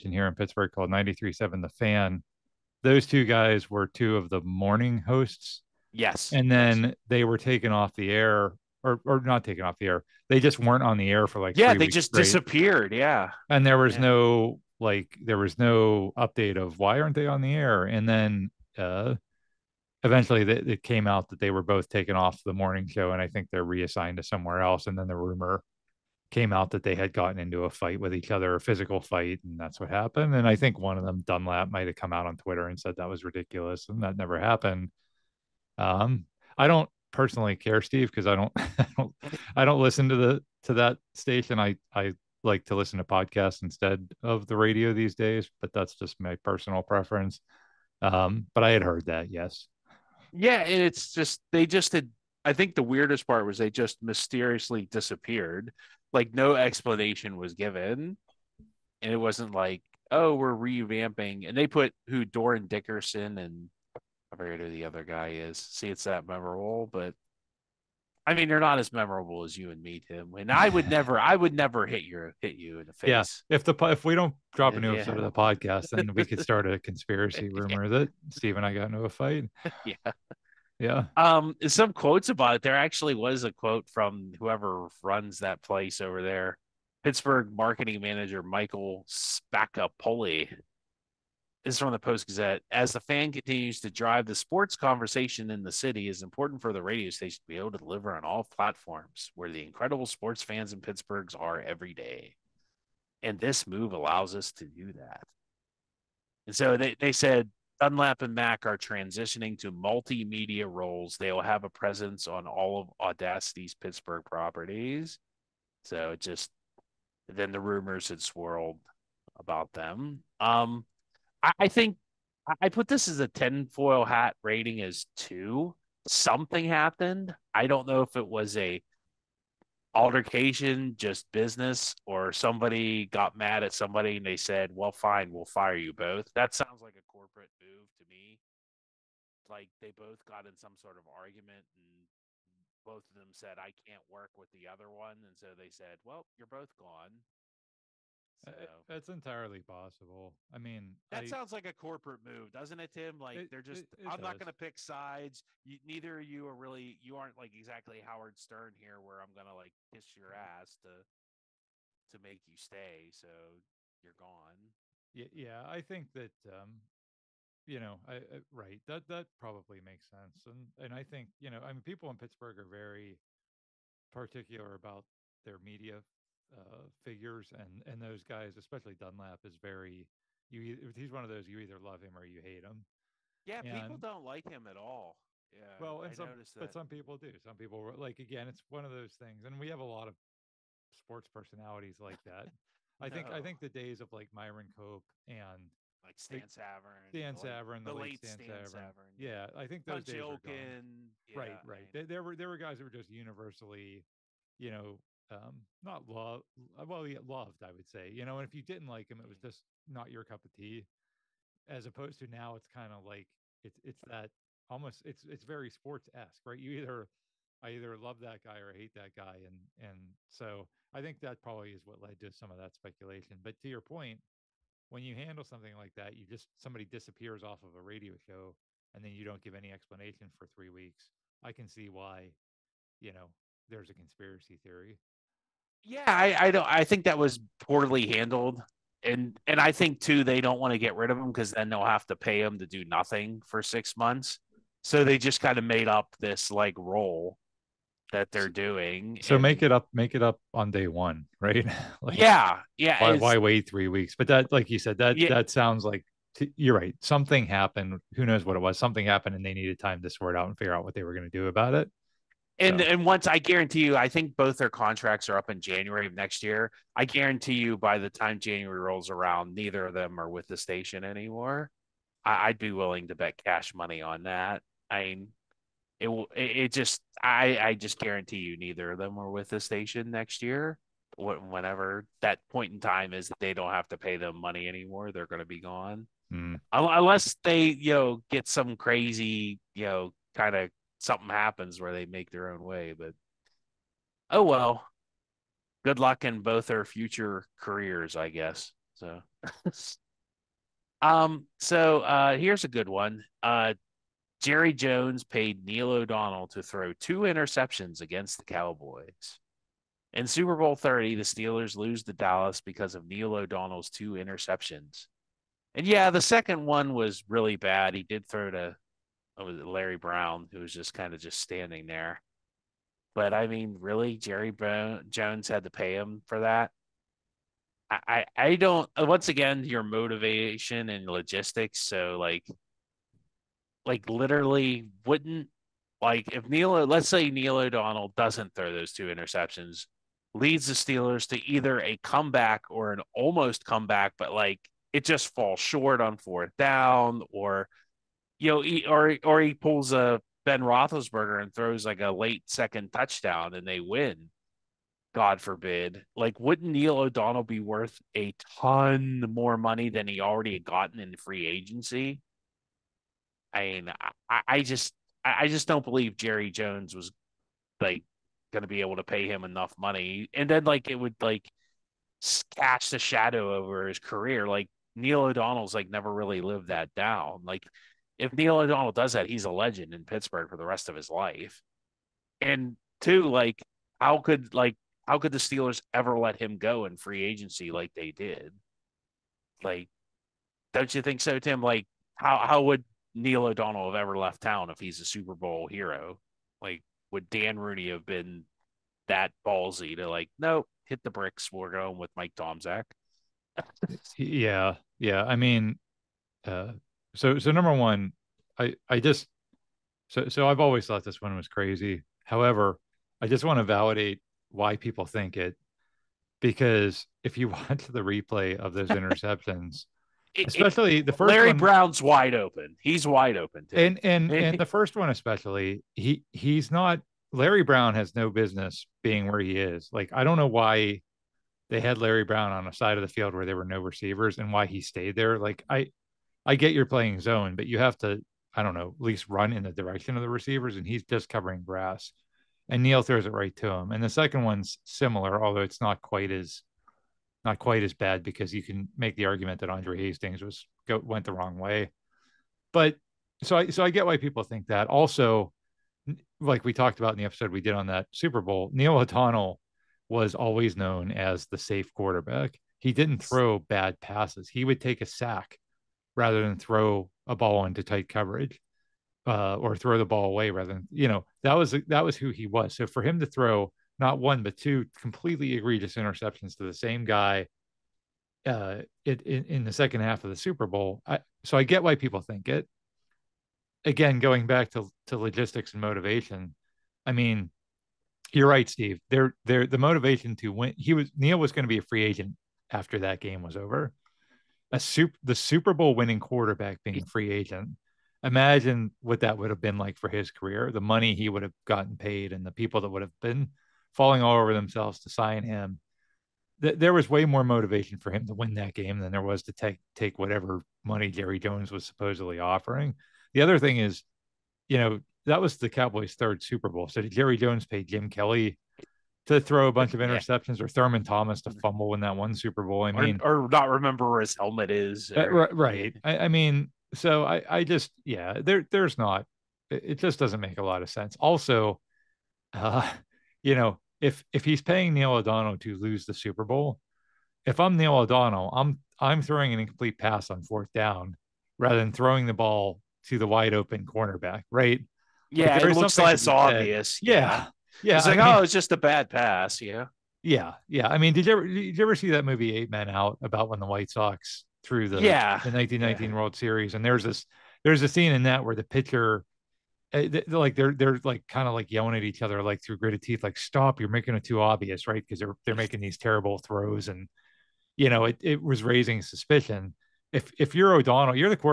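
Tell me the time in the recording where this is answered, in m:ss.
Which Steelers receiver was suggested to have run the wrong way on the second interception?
7:29.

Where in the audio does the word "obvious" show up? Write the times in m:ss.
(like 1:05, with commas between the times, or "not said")
9:06, 9:24.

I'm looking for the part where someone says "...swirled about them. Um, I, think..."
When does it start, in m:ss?
1:58.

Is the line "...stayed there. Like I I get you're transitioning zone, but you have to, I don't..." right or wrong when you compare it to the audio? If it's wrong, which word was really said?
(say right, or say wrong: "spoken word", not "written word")
wrong: "playing", not "transitioning".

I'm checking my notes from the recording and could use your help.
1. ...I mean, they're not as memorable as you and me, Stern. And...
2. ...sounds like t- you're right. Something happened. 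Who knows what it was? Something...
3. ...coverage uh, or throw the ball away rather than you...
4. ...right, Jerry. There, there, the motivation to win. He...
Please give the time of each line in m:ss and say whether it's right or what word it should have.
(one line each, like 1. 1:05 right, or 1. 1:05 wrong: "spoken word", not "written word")
1. 1:08 wrong: "Tim", not "Stern"
2. 4:15 right
3. 7:48 right
4. 8:08 wrong: "Steve", not "Jerry".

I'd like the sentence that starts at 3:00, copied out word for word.
He's one of those you either love him or you hate him.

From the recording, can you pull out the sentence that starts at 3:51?
I can see why, you know, there's a conspiracy theory yeah, I, I don't.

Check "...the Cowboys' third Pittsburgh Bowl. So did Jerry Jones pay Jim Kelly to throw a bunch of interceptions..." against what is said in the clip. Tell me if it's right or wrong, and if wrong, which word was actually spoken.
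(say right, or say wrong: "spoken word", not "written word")
wrong: "Super", not "Pittsburgh".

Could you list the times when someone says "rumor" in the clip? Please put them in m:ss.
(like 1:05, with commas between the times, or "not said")
0:25, 1:17, 1:57.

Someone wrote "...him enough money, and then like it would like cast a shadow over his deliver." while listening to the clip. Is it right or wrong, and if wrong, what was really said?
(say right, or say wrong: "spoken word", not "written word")
wrong: "career", not "deliver".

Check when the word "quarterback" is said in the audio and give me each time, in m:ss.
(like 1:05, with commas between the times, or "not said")
7:41, 8:16.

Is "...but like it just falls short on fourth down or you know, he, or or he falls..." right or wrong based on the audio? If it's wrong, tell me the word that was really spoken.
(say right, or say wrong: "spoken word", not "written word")
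wrong: "pulls", not "falls".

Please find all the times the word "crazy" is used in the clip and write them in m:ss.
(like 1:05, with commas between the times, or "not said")
4:48, 6:51.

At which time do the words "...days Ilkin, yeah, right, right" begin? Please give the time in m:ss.
3:20.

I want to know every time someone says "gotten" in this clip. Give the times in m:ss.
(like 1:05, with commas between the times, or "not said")
0:27, 6:00, 8:21.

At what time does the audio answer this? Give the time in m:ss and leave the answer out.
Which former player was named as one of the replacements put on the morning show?
1:02.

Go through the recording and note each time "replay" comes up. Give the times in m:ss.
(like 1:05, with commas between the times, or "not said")
6:57.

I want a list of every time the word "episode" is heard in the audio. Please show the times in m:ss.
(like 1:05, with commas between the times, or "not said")
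1:14, 7:37.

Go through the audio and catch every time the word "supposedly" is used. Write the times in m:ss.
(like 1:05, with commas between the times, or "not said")
8:31.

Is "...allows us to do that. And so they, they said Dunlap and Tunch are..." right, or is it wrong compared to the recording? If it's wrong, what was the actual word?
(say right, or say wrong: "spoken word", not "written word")
wrong: "Mack", not "Tunch".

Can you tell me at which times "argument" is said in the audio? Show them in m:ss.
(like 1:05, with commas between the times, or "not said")
2:21, 7:29.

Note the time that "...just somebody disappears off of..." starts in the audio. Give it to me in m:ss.
3:46.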